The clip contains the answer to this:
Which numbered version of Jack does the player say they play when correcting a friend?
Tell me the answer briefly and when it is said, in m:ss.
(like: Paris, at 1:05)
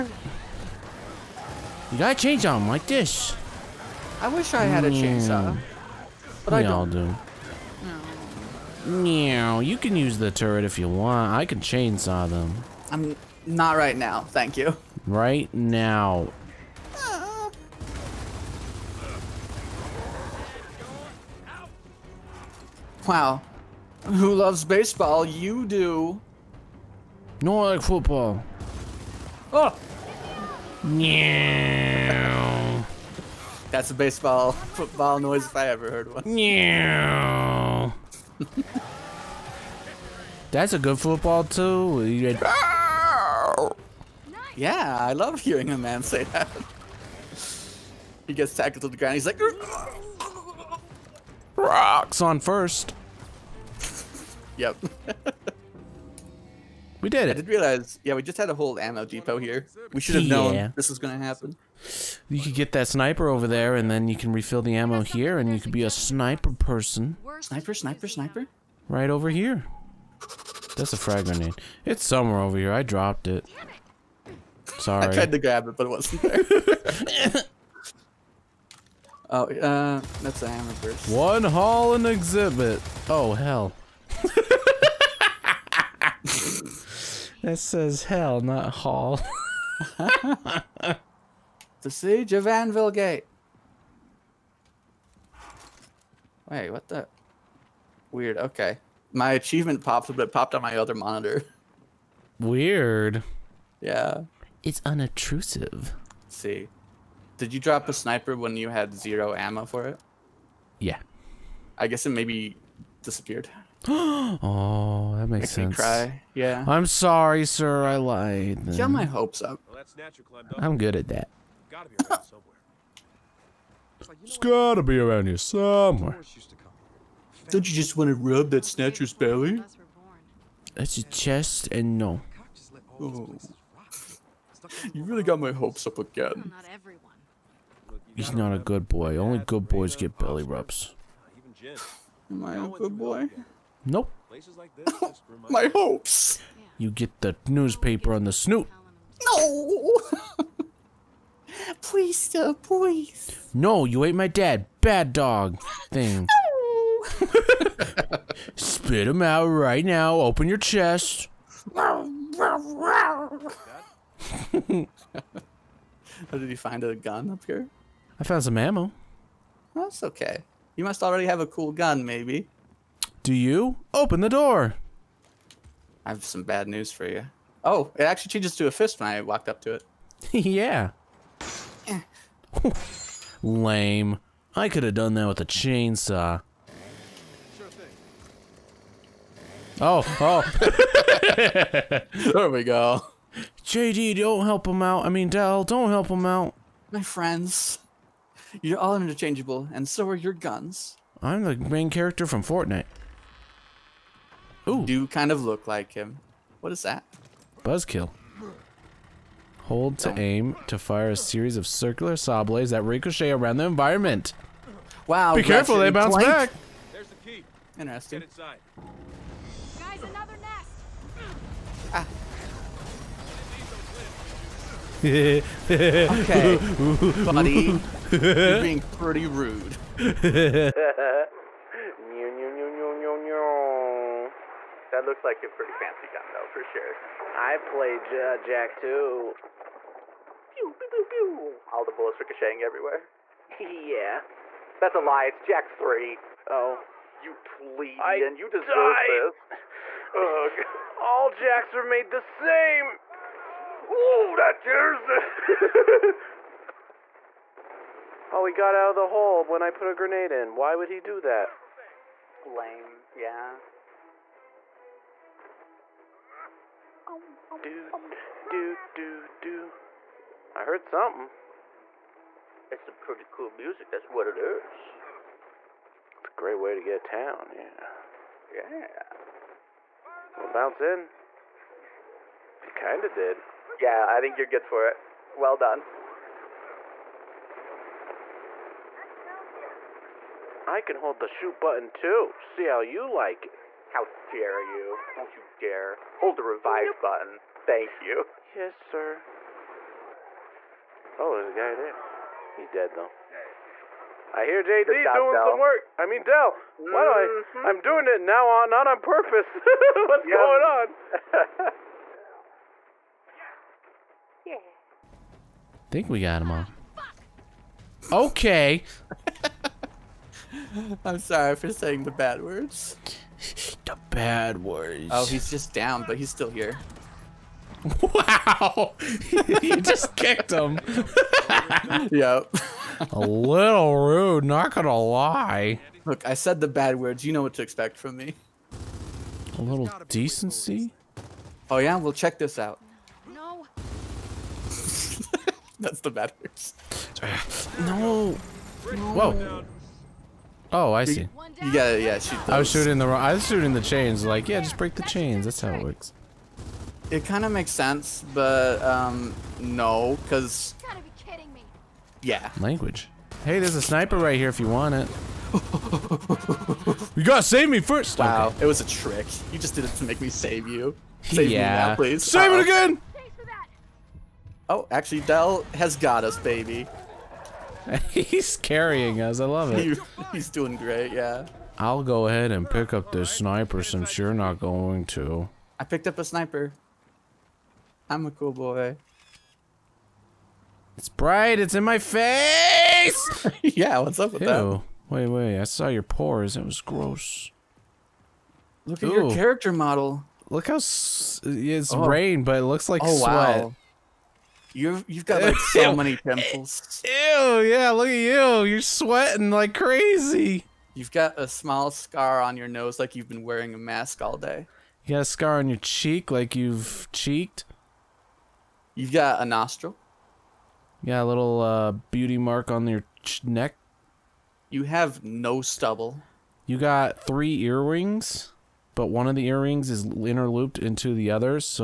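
Jack 3, at 4:05.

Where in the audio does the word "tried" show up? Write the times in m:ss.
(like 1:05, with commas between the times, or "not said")
1:15.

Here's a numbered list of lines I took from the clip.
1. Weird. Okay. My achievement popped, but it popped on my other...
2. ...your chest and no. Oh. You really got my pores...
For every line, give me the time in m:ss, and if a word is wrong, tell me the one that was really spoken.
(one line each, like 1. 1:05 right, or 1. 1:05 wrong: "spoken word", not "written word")
1. 1:38 right
2. 2:10 wrong: "hopes", not "pores".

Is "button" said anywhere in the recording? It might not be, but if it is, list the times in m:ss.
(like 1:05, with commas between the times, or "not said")
4:51, 4:57.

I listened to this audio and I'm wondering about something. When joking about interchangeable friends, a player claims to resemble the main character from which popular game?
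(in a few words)
Fortnite.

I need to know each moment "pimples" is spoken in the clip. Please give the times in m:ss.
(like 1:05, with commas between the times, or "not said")
6:46.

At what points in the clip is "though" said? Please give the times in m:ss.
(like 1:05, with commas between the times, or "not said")
3:56, 5:02.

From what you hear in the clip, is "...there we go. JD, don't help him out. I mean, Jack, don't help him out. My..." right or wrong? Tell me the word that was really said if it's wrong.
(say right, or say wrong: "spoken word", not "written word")
wrong: "Del", not "Jack".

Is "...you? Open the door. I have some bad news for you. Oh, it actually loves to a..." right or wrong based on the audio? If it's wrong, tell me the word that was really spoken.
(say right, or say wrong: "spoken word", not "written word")
wrong: "changes", not "loves".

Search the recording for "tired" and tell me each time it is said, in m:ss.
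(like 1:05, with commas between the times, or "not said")
not said.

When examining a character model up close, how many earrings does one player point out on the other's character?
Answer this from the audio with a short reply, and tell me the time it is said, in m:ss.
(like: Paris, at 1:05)
3, at 7:07.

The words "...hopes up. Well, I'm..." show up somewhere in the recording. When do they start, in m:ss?
1:59.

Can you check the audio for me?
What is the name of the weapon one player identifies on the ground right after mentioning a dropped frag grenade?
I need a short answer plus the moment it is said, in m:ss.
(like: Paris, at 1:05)
Hammerburst, at 1:20.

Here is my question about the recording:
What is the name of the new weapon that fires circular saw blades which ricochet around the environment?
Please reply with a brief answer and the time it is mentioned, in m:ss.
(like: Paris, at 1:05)
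Buzzkill, at 3:27.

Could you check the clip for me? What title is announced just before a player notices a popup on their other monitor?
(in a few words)
The siege of Anvil Gate.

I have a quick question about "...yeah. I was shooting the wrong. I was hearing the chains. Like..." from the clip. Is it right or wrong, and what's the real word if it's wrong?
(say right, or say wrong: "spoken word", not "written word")
wrong: "shooting", not "hearing".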